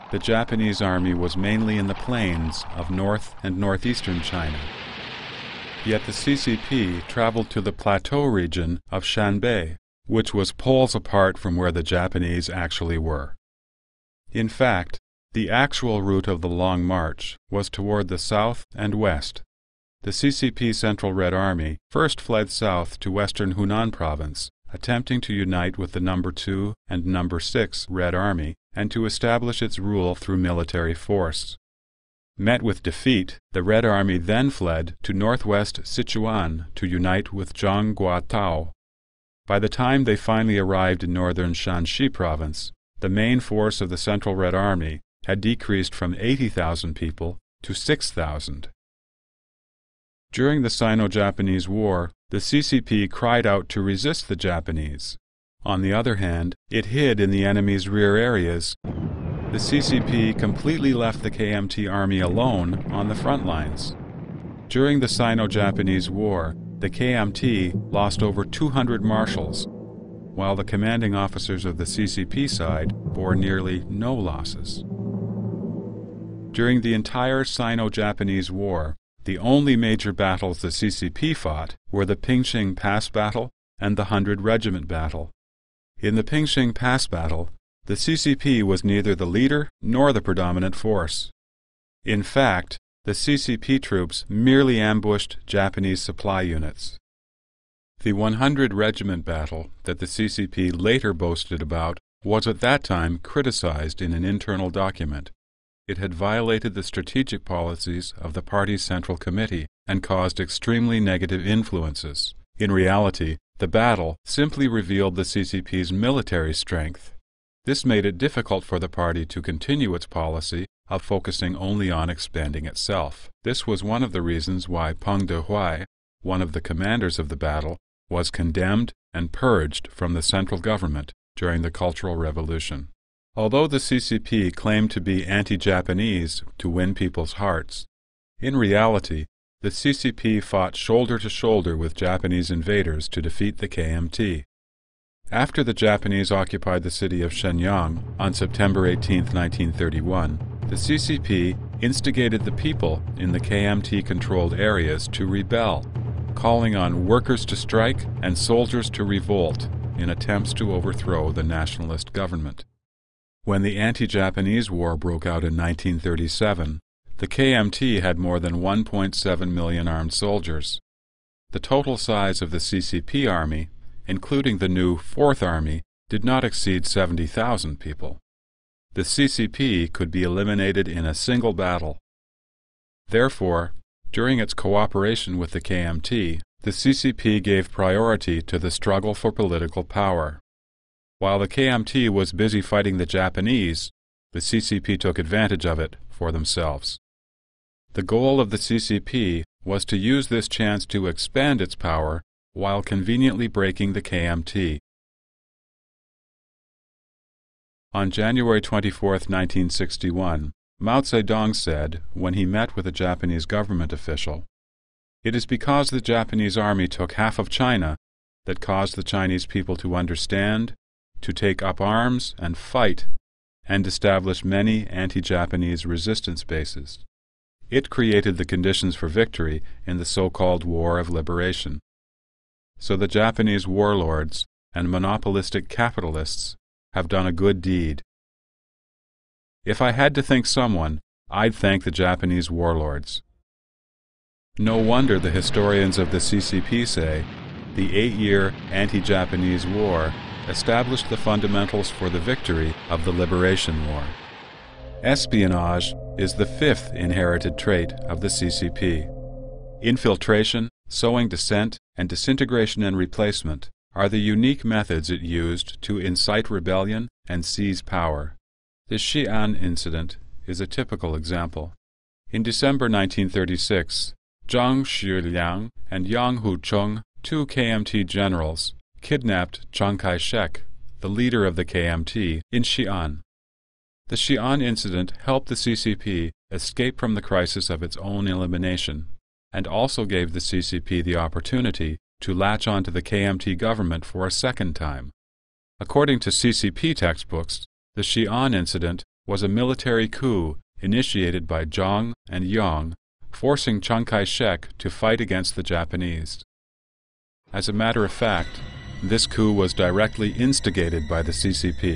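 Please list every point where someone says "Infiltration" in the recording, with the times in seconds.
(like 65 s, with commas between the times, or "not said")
259 s.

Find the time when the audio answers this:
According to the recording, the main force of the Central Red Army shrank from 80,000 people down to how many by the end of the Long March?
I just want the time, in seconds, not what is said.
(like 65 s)
47 s.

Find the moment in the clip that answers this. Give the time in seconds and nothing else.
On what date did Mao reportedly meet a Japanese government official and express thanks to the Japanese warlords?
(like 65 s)
208 s.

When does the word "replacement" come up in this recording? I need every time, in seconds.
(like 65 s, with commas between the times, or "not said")
262 s.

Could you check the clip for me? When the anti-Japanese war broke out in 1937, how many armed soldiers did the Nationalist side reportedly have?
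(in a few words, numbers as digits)
1.7 million.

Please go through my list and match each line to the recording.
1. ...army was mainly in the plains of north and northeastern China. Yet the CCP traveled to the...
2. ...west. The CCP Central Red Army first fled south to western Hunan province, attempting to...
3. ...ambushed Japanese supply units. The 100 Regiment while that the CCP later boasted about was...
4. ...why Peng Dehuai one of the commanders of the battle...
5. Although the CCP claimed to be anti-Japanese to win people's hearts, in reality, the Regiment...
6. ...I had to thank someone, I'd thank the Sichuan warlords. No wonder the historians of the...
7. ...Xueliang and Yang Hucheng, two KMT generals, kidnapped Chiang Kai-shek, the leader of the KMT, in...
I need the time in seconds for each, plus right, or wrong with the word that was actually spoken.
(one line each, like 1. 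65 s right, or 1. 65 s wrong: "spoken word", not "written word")
1. 0 s right
2. 18 s right
3. 94 s wrong: "battle", not "while"
4. 124 s right
5. 133 s wrong: "CCP", not "Regiment"
6. 239 s wrong: "Japanese", not "Sichuan"
7. 274 s right.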